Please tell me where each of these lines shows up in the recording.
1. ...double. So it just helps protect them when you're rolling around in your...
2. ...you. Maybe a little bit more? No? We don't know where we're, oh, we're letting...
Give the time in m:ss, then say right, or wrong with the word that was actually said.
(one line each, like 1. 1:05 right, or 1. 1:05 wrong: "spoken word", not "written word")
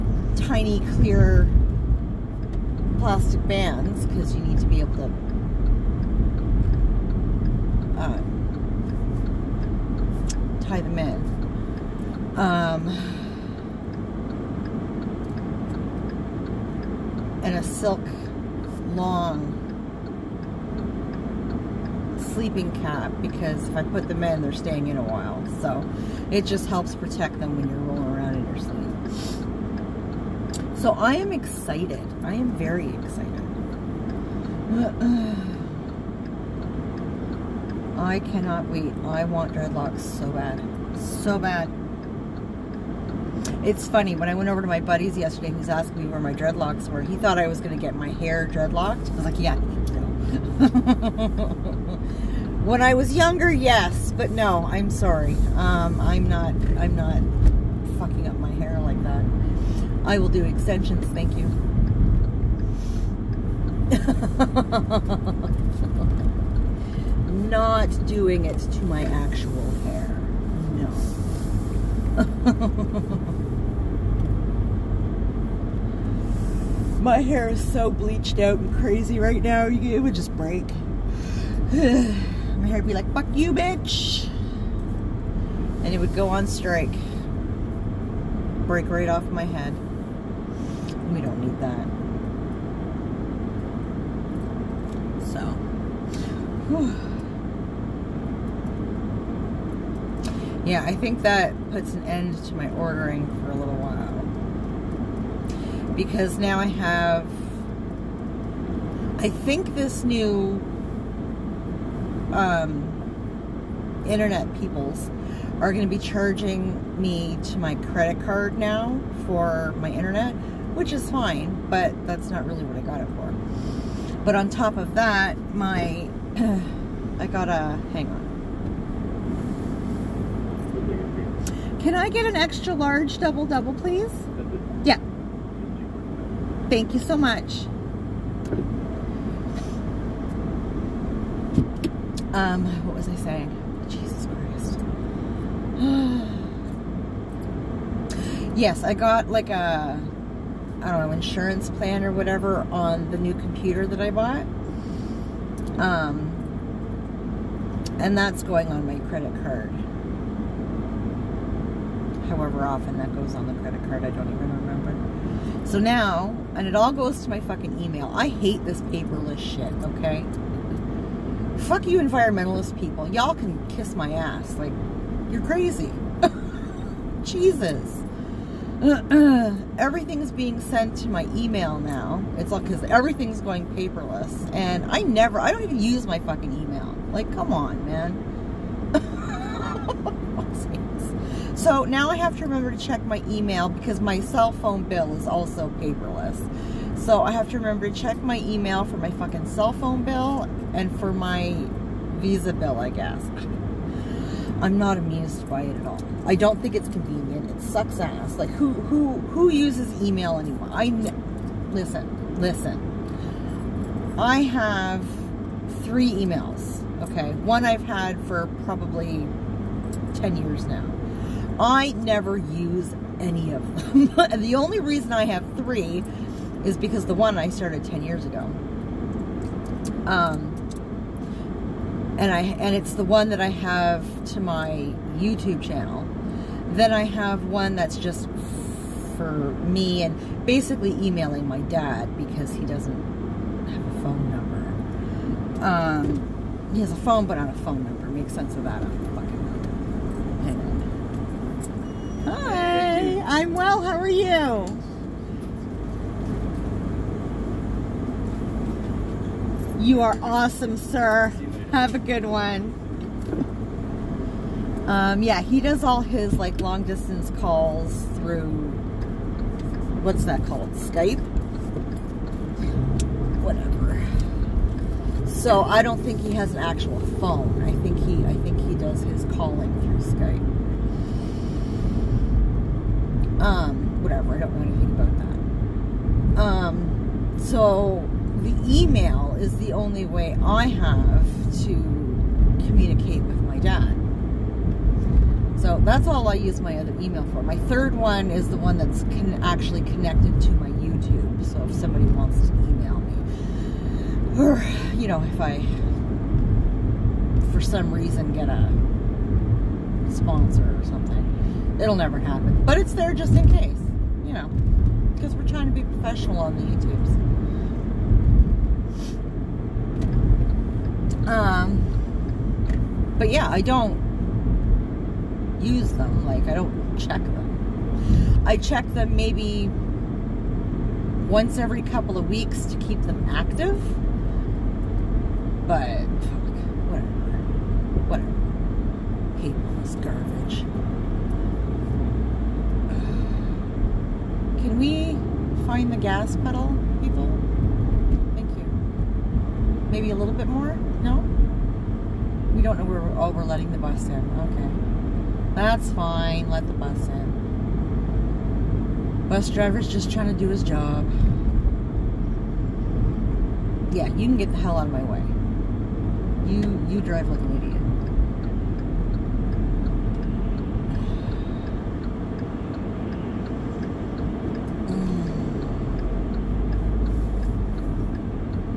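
1. 0:25 wrong: "while", not "double"
2. 5:48 right.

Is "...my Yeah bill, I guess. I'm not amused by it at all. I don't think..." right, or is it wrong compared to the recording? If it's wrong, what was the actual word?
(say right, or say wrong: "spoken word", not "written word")
wrong: "Visa", not "Yeah".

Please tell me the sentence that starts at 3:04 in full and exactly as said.
And I never, I don't even use my fucking email.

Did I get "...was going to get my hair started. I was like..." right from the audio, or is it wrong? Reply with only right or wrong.
wrong.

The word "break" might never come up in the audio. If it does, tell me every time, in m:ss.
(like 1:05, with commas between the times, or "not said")
1:20, 1:28.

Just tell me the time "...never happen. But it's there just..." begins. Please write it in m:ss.
5:11.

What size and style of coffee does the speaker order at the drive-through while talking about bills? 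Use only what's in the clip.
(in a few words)
extra large double double.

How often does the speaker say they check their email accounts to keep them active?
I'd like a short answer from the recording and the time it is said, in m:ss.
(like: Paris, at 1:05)
once every couple of weeks, at 5:31.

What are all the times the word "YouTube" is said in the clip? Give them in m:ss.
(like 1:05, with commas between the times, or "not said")
3:55, 5:00, 5:16.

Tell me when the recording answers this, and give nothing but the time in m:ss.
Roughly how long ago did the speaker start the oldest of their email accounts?
3:40.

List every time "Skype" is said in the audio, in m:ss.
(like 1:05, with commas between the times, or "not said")
4:30, 4:40.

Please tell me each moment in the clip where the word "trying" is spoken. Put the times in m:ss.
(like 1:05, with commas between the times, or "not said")
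5:15, 6:00.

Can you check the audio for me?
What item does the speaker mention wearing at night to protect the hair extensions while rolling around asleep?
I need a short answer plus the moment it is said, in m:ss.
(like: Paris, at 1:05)
silk long sleeping cap, at 0:17.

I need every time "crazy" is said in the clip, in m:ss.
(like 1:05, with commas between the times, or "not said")
1:18, 2:55.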